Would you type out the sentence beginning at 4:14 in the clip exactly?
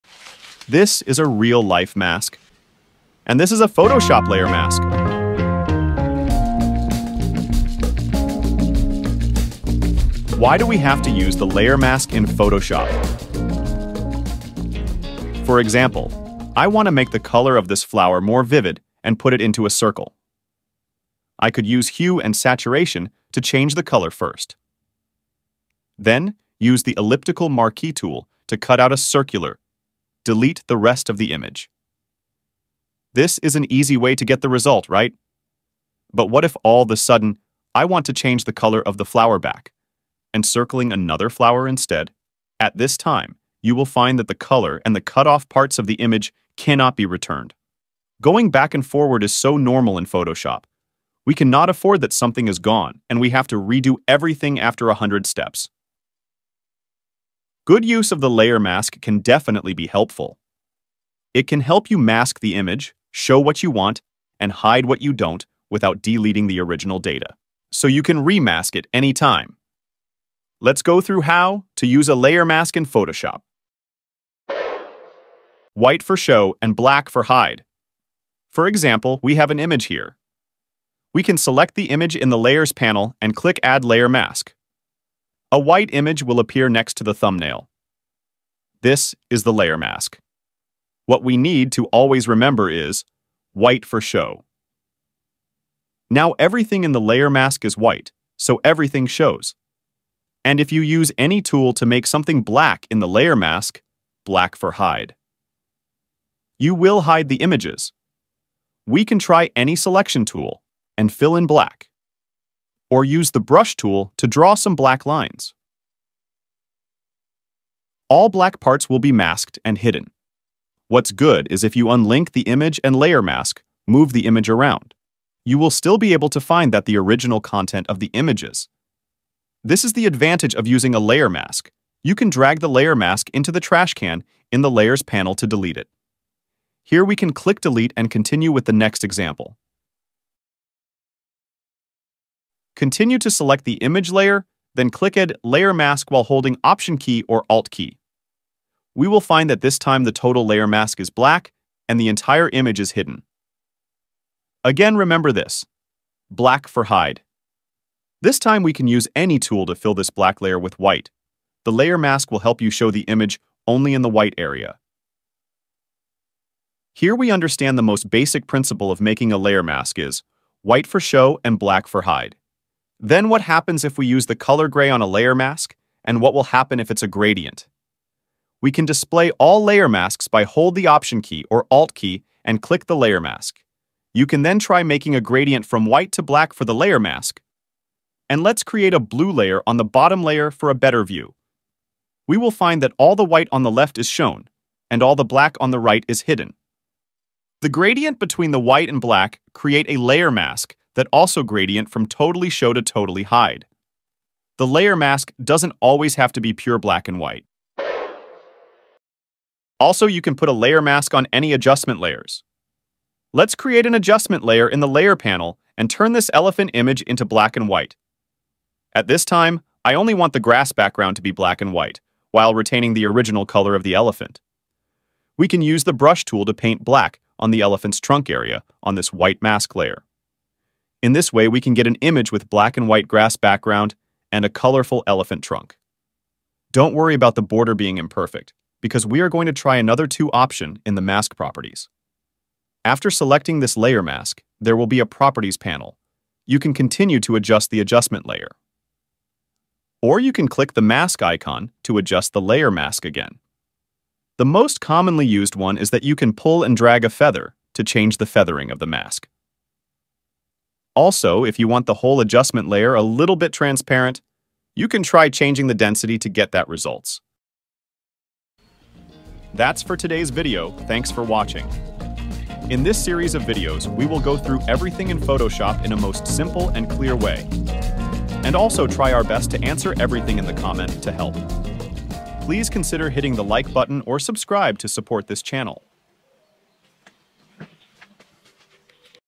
The most commonly used one is that you can pull and drag a feather to change the feathering of the mask.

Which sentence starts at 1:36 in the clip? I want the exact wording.
Now everything in the layer mask is white, so everything shows.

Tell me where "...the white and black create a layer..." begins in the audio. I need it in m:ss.
3:18.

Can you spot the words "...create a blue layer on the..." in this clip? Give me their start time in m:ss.
3:08.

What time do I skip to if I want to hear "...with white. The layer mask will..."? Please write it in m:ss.
2:40.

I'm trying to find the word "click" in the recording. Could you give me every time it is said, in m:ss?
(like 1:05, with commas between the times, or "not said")
1:23, 2:17, 2:24, 3:02, 4:10.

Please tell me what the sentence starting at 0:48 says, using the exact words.
Going back and forward is so normal in Photoshop.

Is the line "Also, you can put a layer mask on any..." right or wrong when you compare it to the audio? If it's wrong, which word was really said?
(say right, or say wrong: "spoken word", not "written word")
right.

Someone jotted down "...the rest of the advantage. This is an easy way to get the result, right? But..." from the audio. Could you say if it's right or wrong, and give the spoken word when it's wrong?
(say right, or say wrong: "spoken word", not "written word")
wrong: "image", not "advantage".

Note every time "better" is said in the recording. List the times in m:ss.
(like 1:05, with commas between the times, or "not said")
3:10.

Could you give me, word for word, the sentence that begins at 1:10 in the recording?
Let's go through how to use a layer mask in Photoshop.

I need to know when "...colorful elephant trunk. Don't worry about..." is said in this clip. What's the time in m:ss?
3:54.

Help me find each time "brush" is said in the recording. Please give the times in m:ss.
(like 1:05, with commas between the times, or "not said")
1:53, 3:45.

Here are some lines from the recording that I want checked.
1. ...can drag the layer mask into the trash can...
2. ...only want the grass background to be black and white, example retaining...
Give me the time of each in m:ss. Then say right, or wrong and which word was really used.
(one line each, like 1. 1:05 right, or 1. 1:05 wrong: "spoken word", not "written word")
1. 2:12 right
2. 3:39 wrong: "while", not "example".